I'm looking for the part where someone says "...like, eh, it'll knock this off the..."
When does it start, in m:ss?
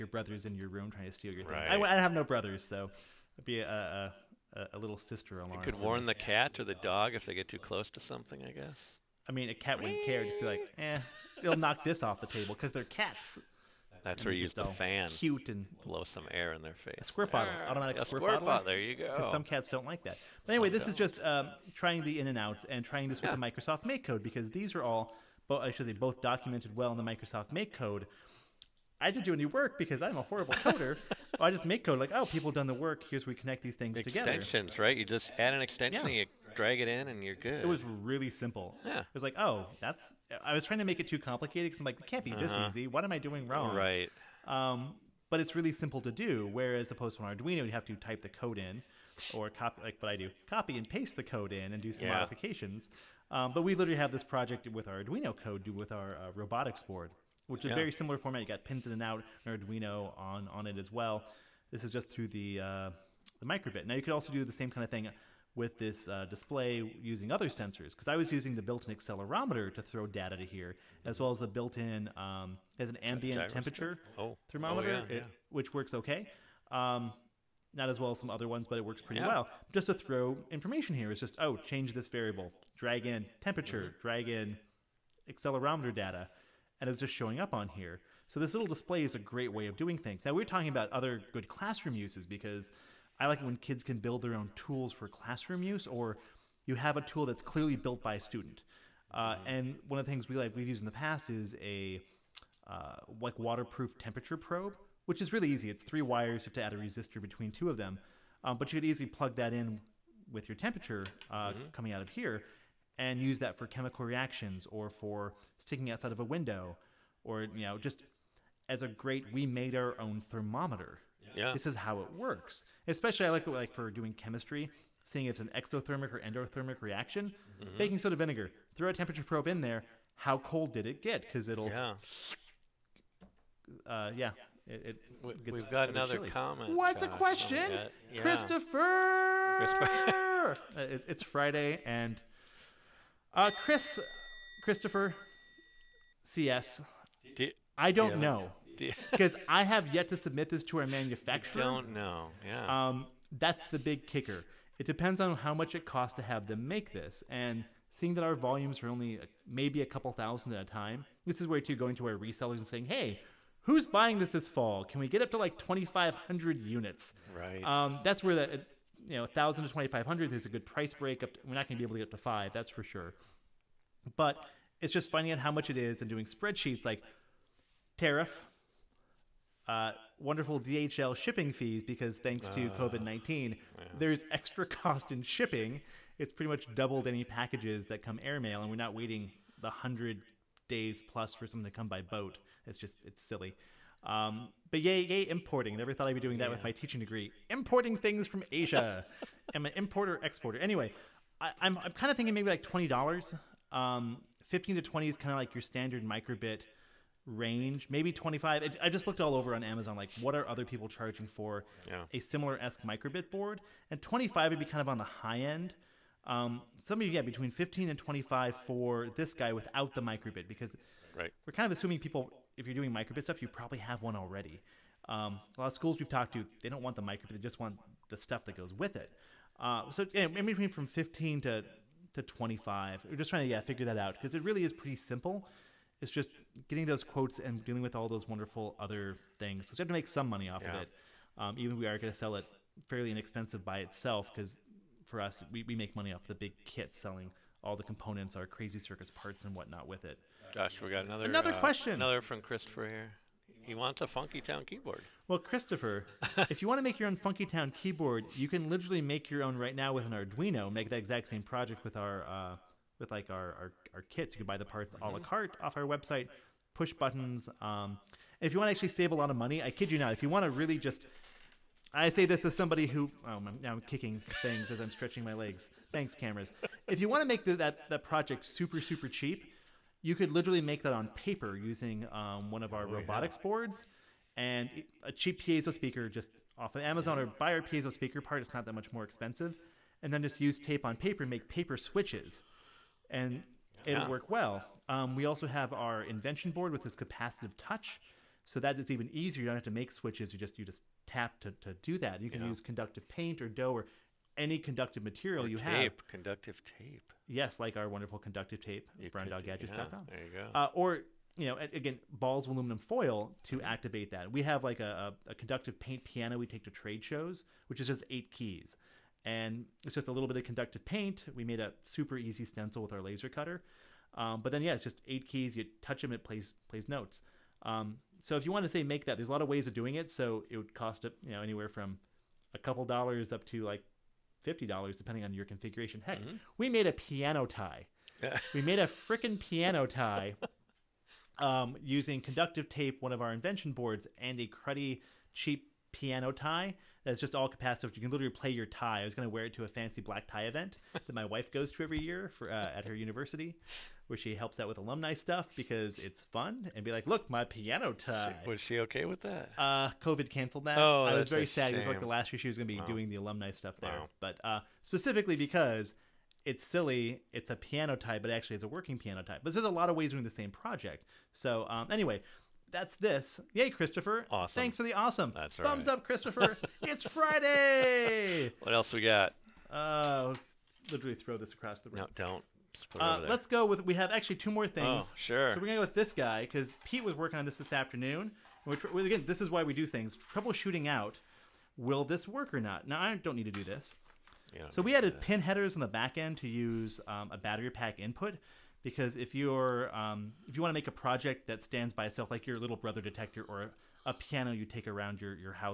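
0:10.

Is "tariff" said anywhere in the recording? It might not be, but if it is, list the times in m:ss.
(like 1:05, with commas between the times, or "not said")
2:57.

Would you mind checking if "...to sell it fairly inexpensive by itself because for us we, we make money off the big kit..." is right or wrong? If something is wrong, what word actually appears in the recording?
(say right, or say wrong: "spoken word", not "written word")
right.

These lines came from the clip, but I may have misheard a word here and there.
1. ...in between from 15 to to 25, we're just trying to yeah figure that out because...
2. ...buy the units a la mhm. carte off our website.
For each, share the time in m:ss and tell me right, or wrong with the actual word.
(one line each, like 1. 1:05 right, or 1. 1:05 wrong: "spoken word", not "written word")
1. 3:50 right
2. 4:24 wrong: "parts", not "units".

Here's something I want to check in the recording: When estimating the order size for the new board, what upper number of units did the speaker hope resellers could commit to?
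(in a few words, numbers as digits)
2,500.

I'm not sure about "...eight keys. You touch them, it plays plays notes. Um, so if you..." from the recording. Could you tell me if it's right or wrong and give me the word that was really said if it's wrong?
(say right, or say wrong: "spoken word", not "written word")
right.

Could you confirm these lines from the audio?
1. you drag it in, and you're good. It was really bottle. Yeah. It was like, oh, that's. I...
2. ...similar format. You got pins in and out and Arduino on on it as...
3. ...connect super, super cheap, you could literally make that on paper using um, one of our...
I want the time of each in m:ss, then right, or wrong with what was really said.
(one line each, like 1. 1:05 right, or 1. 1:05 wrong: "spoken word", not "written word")
1. 0:36 wrong: "simple", not "bottle"
2. 0:57 right
3. 4:38 wrong: "project", not "connect".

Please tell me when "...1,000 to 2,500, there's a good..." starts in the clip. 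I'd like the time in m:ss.
2:49.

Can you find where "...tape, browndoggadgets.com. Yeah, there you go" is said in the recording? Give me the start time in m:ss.
5:08.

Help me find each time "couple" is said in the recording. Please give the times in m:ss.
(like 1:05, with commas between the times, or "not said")
2:39, 5:32.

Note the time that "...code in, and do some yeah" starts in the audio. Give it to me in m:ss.
0:51.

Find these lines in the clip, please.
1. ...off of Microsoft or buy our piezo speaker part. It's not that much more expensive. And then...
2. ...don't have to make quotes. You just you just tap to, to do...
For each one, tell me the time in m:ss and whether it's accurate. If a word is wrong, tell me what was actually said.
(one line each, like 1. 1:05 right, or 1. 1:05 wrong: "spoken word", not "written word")
1. 4:46 wrong: "Amazon", not "Microsoft"
2. 4:59 wrong: "switches", not "quotes".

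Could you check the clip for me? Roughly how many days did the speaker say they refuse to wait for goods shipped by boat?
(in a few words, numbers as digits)
100.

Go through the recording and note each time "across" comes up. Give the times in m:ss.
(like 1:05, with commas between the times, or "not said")
6:21.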